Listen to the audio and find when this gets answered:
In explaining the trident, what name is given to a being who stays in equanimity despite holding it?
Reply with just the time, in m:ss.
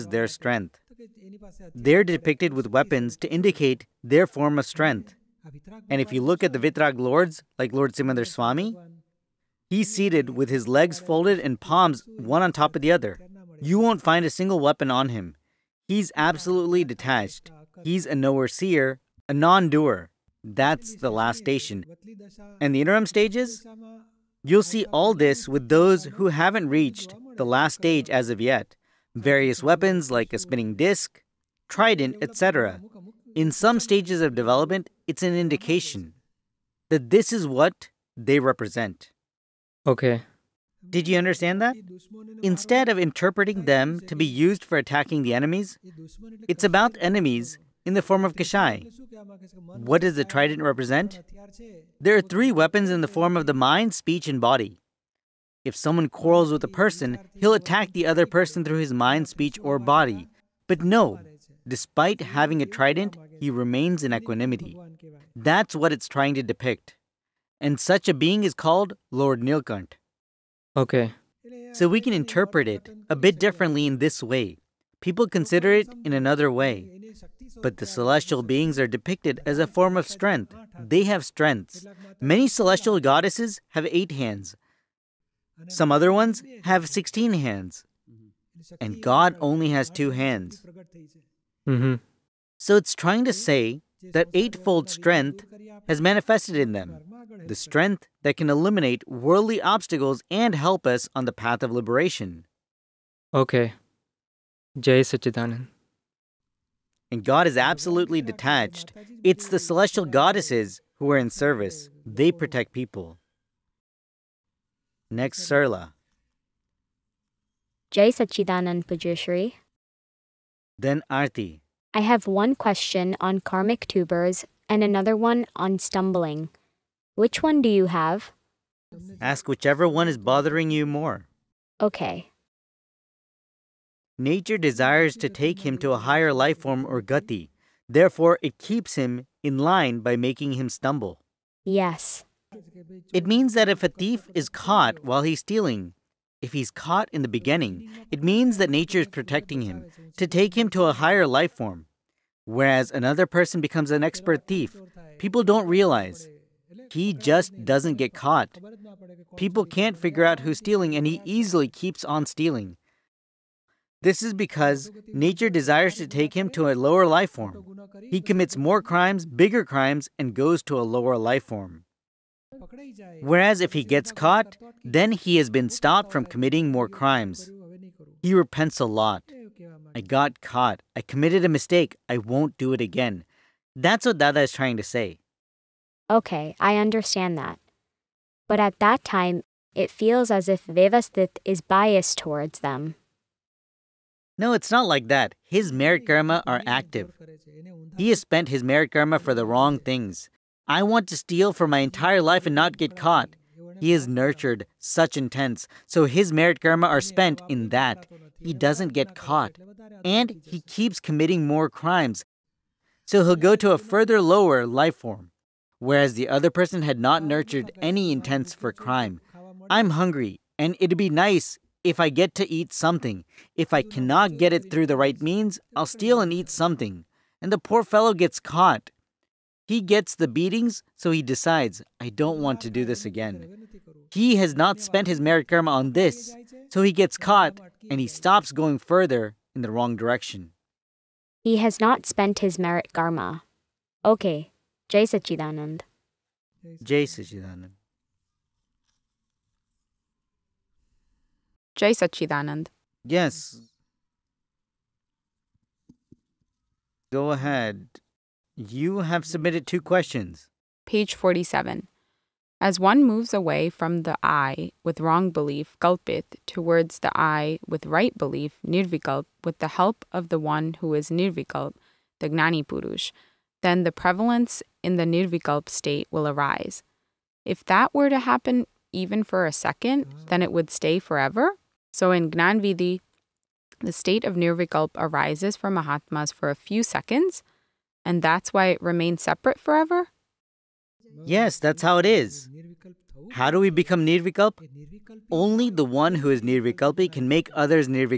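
1:09.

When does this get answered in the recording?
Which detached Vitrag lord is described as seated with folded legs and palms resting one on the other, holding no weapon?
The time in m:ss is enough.
0:07.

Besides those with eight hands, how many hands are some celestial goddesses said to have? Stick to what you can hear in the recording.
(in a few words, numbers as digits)
16.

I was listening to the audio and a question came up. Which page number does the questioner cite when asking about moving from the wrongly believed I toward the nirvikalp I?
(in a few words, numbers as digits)
47.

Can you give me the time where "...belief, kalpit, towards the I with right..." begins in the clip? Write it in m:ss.
4:25.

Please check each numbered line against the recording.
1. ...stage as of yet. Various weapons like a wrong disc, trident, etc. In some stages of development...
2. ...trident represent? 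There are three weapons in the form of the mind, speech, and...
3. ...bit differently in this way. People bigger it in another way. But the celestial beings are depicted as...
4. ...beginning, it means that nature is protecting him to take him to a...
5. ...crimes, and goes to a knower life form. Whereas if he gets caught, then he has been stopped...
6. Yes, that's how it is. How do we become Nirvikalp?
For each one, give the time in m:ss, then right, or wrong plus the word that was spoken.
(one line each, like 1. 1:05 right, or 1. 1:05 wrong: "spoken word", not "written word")
1. 0:27 wrong: "spinning", not "wrong"
2. 0:50 right
3. 1:13 wrong: "consider", not "bigger"
4. 2:27 right
5. 2:49 wrong: "lower", not "knower"
6. 4:51 right.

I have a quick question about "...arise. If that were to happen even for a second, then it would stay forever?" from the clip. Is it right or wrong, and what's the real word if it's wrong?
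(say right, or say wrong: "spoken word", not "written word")
right.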